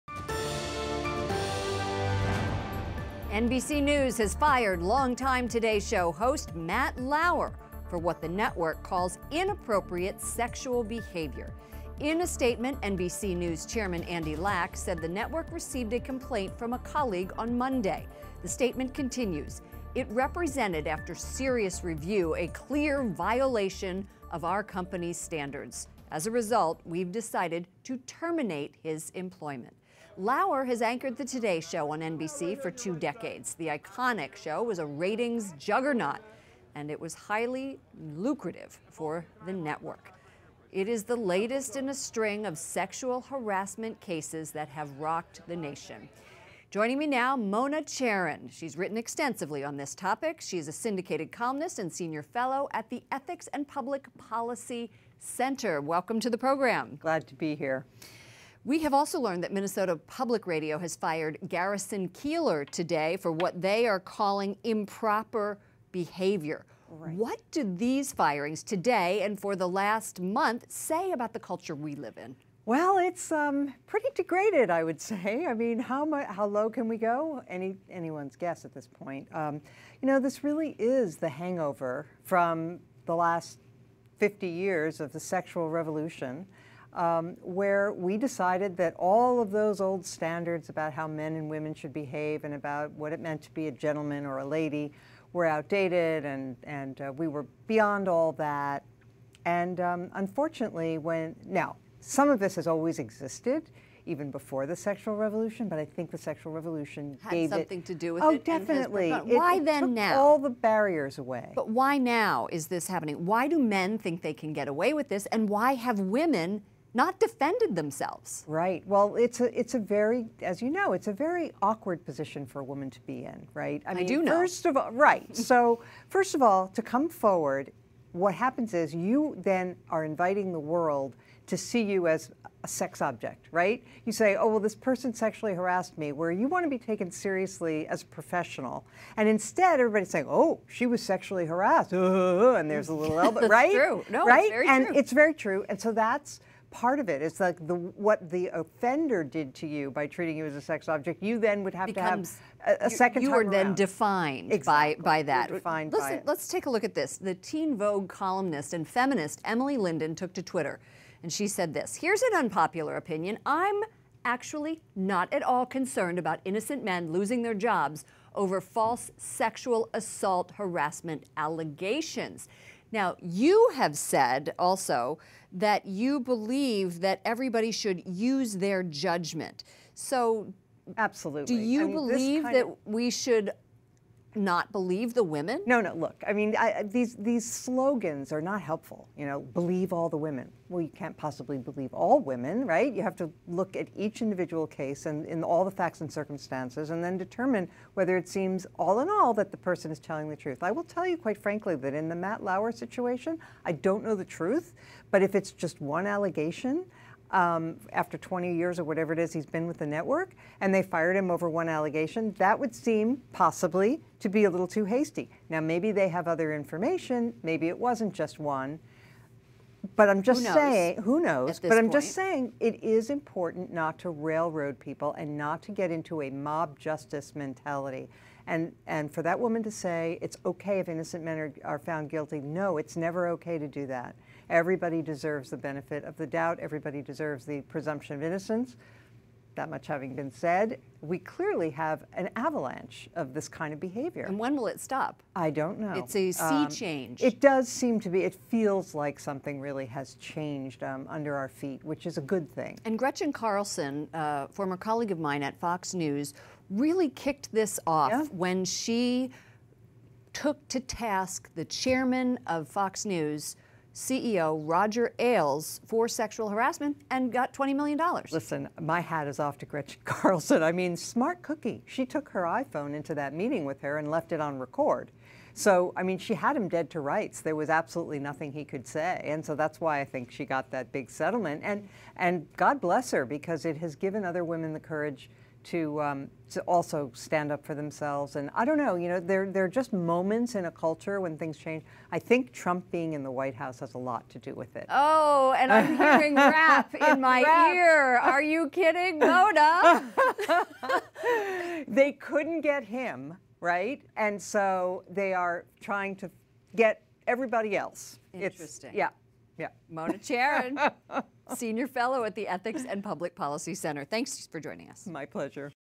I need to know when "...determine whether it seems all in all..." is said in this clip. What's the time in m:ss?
3:17.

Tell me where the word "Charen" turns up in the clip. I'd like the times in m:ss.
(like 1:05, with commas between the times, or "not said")
0:47, 5:10.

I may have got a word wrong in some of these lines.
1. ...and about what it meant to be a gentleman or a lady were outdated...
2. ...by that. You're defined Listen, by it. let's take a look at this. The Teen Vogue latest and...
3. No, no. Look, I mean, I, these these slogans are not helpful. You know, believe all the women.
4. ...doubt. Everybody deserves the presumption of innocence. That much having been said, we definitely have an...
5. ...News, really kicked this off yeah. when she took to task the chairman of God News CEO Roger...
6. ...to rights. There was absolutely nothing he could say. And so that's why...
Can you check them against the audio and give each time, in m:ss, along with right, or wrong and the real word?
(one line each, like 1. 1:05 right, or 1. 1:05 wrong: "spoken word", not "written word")
1. 1:32 right
2. 2:35 wrong: "columnist", not "latest"
3. 3:05 right
4. 3:56 wrong: "clearly", not "definitely"
5. 4:15 wrong: "Fox", not "God"
6. 4:36 right.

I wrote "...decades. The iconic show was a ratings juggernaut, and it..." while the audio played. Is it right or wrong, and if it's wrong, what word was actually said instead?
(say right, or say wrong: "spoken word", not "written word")
right.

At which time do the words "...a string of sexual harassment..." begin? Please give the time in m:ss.
0:41.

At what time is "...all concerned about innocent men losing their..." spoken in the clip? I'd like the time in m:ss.
2:45.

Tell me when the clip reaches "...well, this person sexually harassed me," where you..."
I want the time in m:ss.
2:14.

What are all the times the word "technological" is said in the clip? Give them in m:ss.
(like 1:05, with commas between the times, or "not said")
not said.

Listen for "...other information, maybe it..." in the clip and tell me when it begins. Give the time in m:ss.
3:36.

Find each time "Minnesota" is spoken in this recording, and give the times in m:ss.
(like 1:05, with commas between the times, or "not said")
0:59.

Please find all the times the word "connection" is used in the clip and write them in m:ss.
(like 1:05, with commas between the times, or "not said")
not said.